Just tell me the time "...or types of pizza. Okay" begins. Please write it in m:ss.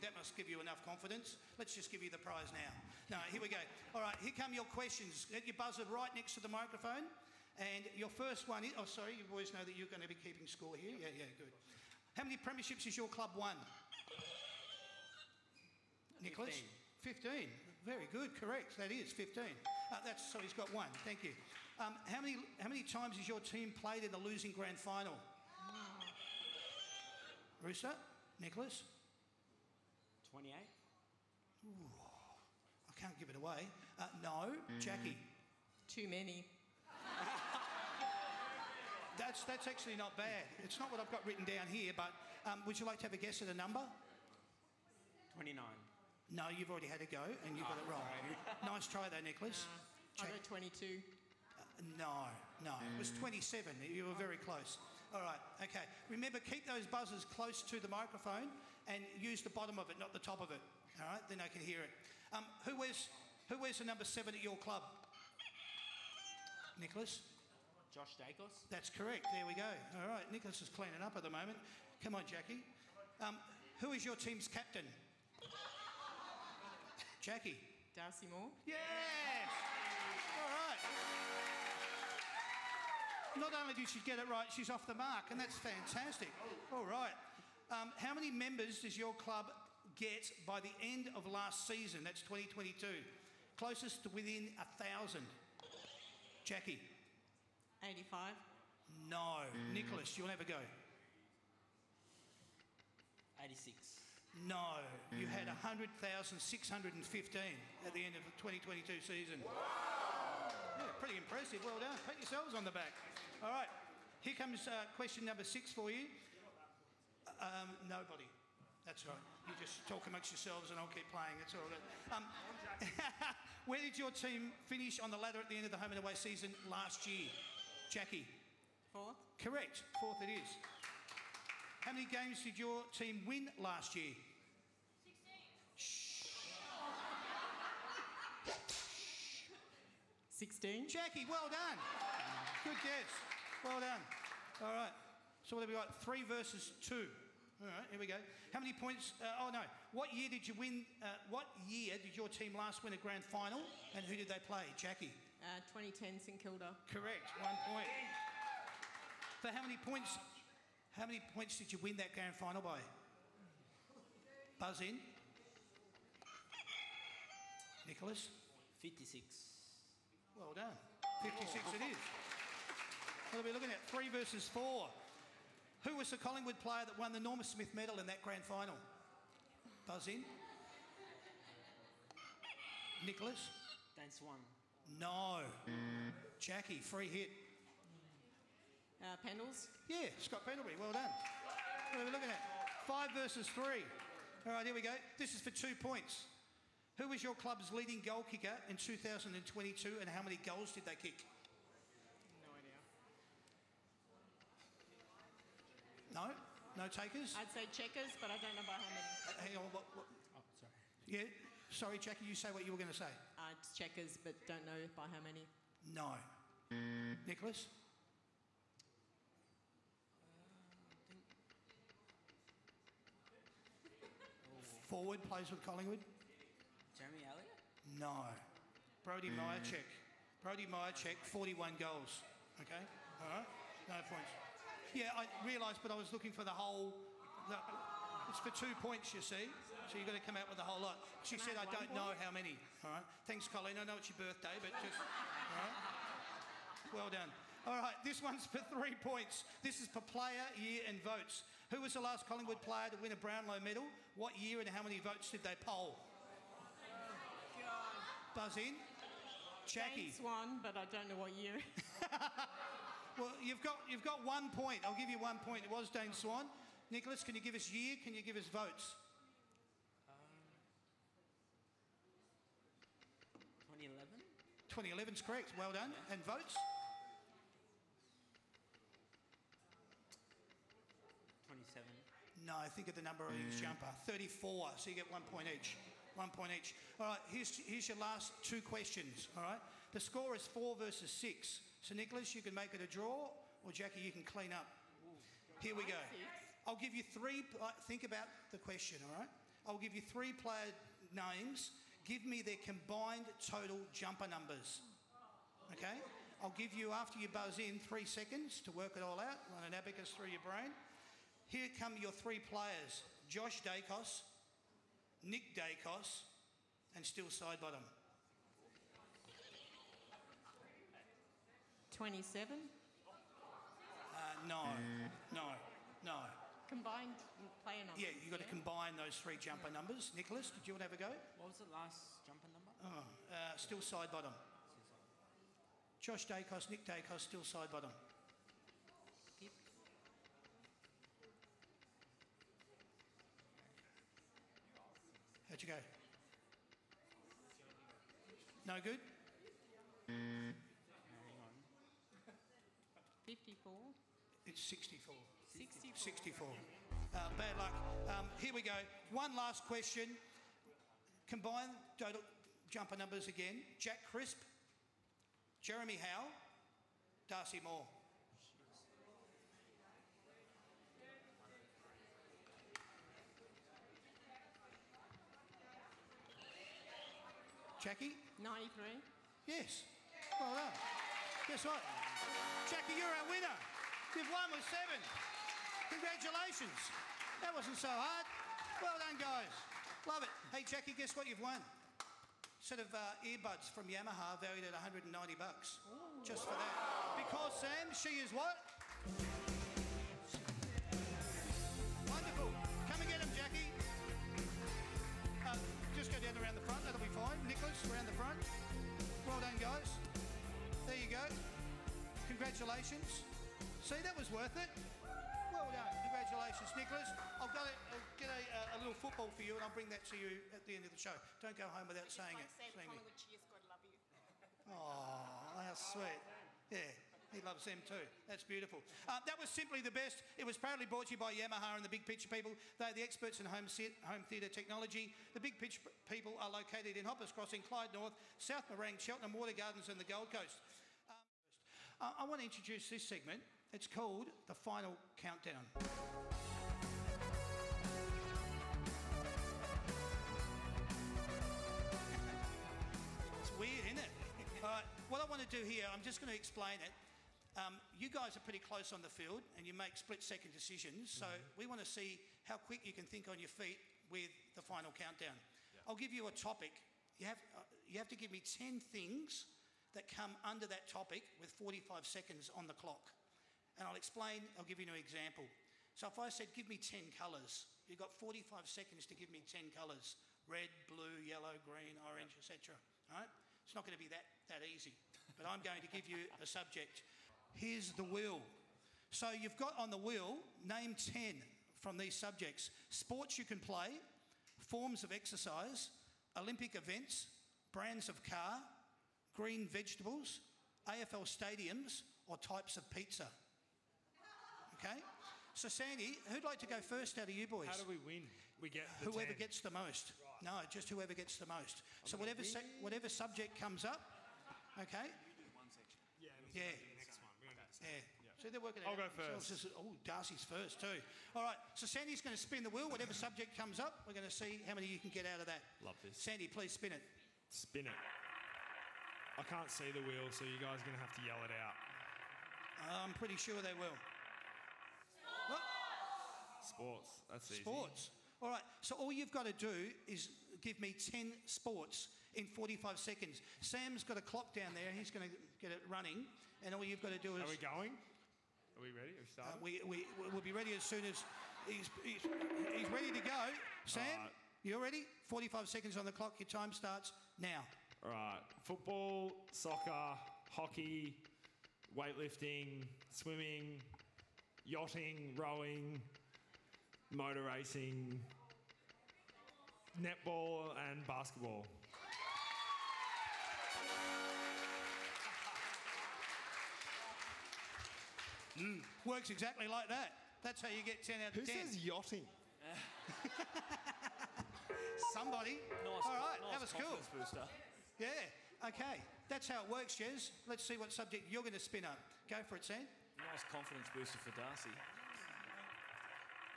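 8:22.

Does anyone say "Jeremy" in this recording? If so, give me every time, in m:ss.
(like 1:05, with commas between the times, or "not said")
3:46, 6:05.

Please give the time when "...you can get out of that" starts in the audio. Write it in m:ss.
8:44.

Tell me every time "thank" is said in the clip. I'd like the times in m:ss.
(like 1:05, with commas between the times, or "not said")
0:20, 4:03.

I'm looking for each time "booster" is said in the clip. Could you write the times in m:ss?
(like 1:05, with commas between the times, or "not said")
9:47, 9:53.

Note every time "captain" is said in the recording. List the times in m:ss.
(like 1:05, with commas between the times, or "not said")
1:14.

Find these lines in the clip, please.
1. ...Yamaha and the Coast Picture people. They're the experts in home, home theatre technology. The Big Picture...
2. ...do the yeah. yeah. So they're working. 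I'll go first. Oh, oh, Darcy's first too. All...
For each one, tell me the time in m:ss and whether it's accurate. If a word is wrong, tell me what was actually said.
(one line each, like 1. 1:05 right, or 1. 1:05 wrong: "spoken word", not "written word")
1. 7:11 wrong: "Big", not "Coast"
2. 8:37 right.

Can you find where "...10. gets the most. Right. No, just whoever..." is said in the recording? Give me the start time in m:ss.
8:29.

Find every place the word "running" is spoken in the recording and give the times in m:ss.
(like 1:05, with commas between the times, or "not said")
9:05.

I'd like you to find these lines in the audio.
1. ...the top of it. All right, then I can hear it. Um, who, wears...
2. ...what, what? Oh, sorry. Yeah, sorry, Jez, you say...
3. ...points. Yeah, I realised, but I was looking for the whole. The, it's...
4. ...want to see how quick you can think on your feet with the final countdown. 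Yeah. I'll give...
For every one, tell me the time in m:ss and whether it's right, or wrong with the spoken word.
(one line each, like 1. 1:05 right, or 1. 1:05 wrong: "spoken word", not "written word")
1. 1:00 right
2. 3:29 wrong: "Jackie", not "Jez"
3. 3:54 right
4. 7:41 right.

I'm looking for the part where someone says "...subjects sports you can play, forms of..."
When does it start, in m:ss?
8:12.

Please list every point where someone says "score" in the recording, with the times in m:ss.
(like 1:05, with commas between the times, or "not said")
0:10, 4:50.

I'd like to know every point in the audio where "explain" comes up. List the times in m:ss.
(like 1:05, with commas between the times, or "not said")
7:36, 7:53.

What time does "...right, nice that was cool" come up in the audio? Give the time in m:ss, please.
9:46.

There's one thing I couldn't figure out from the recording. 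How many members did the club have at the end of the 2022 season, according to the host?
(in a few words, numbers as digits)
100,615.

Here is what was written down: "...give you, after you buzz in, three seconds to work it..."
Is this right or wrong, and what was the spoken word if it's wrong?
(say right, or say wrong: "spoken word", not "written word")
right.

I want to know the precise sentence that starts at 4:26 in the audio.
Nicholas, can you give us year?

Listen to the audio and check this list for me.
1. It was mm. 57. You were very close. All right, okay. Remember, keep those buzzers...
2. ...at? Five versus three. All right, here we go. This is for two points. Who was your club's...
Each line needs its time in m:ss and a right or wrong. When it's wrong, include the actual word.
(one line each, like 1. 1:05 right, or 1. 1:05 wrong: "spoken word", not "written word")
1. 0:52 wrong: "27", not "57"
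2. 3:12 right.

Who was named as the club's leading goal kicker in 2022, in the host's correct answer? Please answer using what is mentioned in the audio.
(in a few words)
Brody Mihocek.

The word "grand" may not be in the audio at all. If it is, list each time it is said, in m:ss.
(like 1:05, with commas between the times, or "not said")
0:24, 2:32, 2:42, 2:58.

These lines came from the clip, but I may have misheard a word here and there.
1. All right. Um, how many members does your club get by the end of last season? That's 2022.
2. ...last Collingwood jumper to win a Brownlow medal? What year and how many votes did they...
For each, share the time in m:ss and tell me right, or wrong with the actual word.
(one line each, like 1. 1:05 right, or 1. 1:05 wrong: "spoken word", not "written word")
1. 1:26 right
2. 4:12 wrong: "player", not "jumper".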